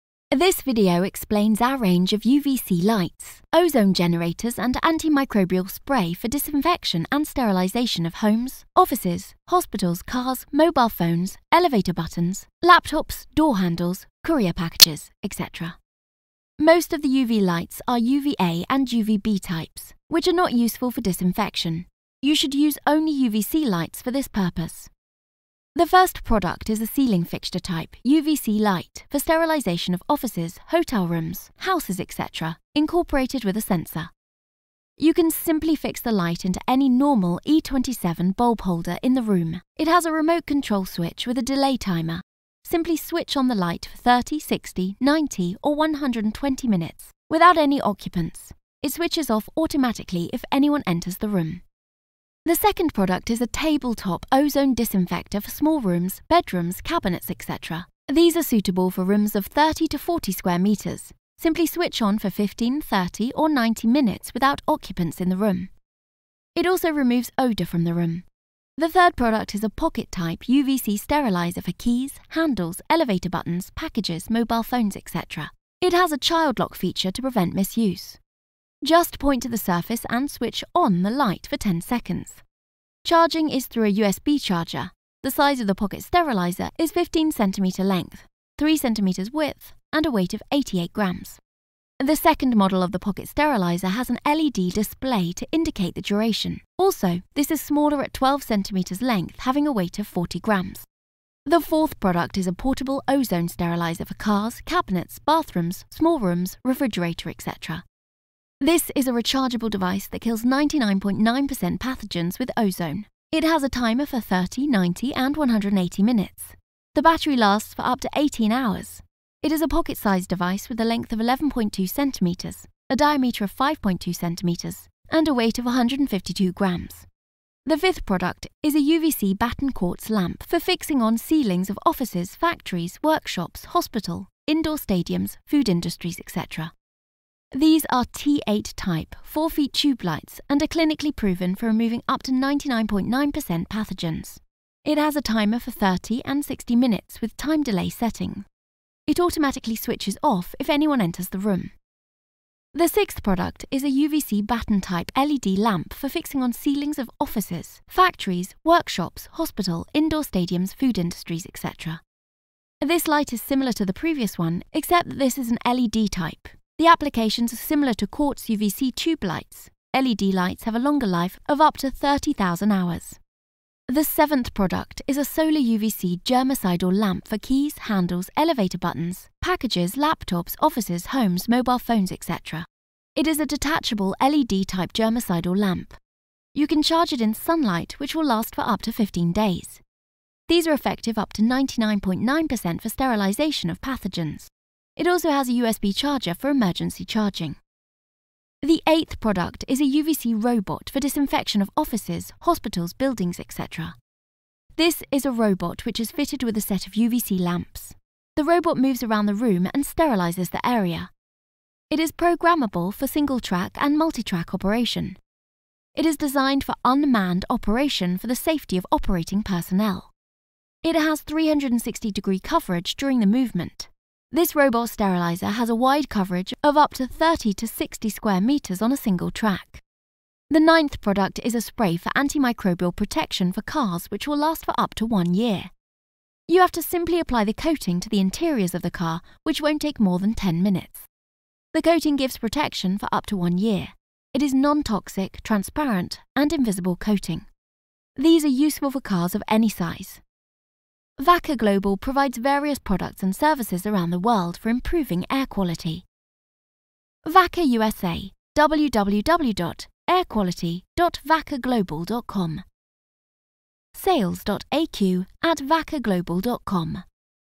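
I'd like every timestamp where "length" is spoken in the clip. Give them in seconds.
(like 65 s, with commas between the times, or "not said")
87 s, 99 s, 120 s.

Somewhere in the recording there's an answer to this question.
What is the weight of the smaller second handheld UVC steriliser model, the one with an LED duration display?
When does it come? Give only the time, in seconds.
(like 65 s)
100 s.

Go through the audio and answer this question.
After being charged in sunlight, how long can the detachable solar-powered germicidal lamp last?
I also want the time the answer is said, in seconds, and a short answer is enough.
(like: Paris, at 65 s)
15 days, at 188 s.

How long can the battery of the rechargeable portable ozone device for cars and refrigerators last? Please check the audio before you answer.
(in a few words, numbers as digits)
18 hours.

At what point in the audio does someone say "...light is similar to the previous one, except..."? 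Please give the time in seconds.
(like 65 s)
163 s.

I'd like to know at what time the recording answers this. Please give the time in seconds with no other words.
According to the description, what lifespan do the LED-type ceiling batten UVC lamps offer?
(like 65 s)
171 s.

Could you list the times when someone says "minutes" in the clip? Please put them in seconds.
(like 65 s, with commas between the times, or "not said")
46 s, 63 s, 116 s, 146 s, 240 s.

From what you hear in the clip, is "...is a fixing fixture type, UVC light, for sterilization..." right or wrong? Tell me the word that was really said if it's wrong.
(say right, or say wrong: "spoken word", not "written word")
wrong: "ceiling", not "fixing".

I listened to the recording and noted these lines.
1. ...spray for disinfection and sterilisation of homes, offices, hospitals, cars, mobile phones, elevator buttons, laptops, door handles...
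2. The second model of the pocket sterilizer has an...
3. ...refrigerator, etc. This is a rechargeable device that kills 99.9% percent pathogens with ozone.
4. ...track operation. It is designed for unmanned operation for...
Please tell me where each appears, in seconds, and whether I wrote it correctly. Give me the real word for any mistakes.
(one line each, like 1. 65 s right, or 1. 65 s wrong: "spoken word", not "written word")
1. 5 s right
2. 92 s right
3. 106 s right
4. 214 s right.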